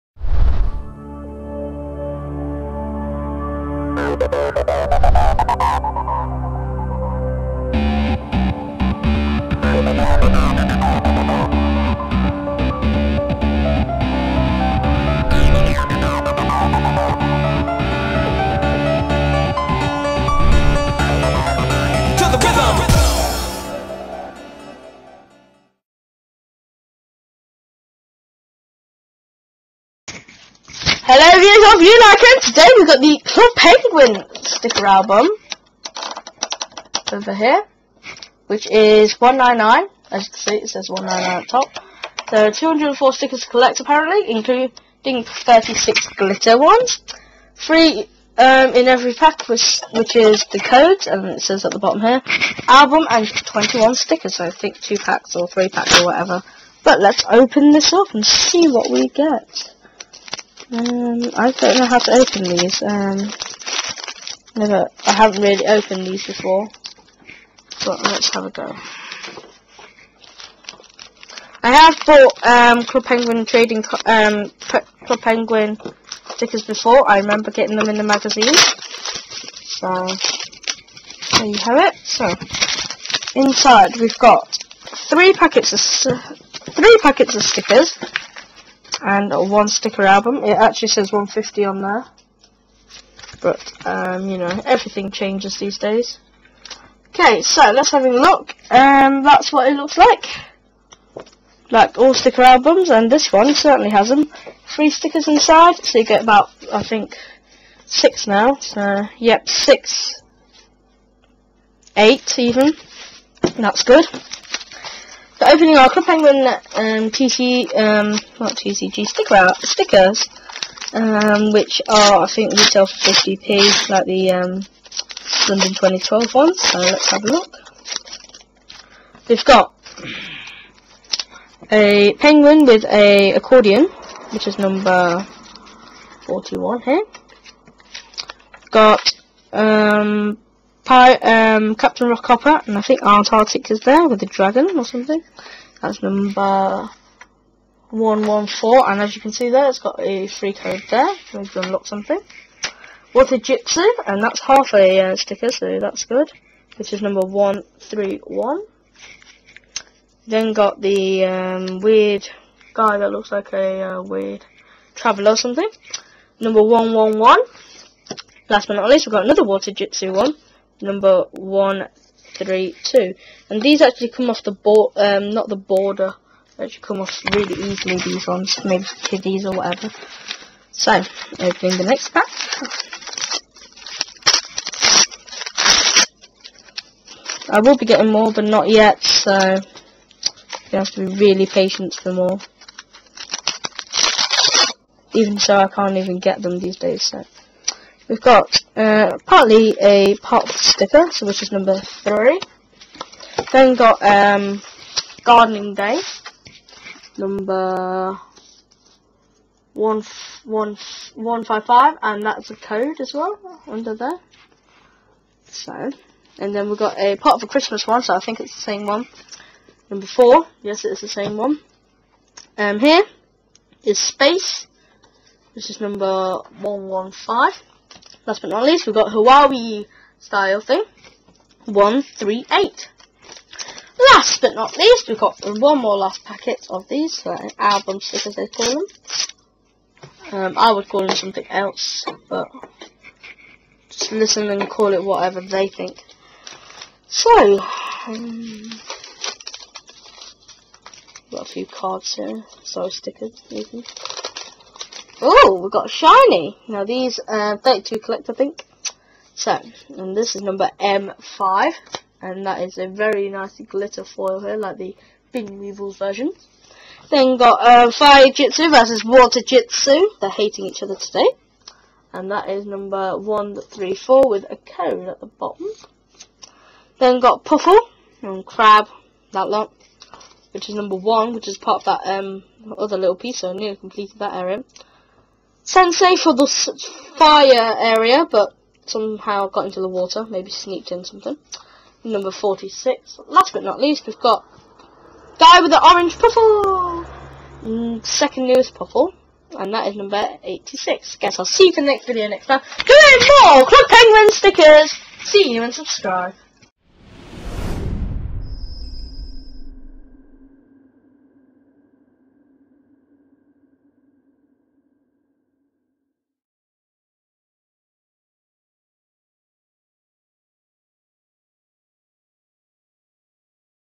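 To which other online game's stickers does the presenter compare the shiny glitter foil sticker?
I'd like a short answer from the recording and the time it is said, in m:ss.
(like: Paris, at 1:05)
Bin Weevils, at 4:25.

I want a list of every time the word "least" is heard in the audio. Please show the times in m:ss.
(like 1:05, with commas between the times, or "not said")
2:48, 3:48, 3:54, 4:53.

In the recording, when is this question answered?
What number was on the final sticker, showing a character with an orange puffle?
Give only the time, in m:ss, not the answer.
5:00.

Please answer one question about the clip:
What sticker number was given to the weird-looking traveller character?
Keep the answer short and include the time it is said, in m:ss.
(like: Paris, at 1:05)
111, at 2:46.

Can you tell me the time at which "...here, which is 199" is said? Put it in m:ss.
0:37.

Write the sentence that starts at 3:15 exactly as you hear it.
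Even so, I can't even get them these days, so...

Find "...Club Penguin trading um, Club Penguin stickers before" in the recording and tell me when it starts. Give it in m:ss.
1:12.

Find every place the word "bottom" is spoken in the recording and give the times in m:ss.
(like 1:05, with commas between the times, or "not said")
0:51, 4:35.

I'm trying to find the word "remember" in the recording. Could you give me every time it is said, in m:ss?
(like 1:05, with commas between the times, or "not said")
1:17.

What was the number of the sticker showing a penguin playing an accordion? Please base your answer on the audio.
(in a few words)
41.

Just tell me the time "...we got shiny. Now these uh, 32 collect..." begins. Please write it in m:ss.
4:15.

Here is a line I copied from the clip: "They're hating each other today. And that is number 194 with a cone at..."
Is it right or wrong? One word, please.
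wrong.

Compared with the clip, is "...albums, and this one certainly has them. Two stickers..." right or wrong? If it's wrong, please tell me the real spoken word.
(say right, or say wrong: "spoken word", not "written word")
wrong: "Three", not "Two".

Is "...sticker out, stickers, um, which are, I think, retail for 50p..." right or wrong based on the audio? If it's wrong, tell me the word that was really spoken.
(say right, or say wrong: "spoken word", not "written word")
right.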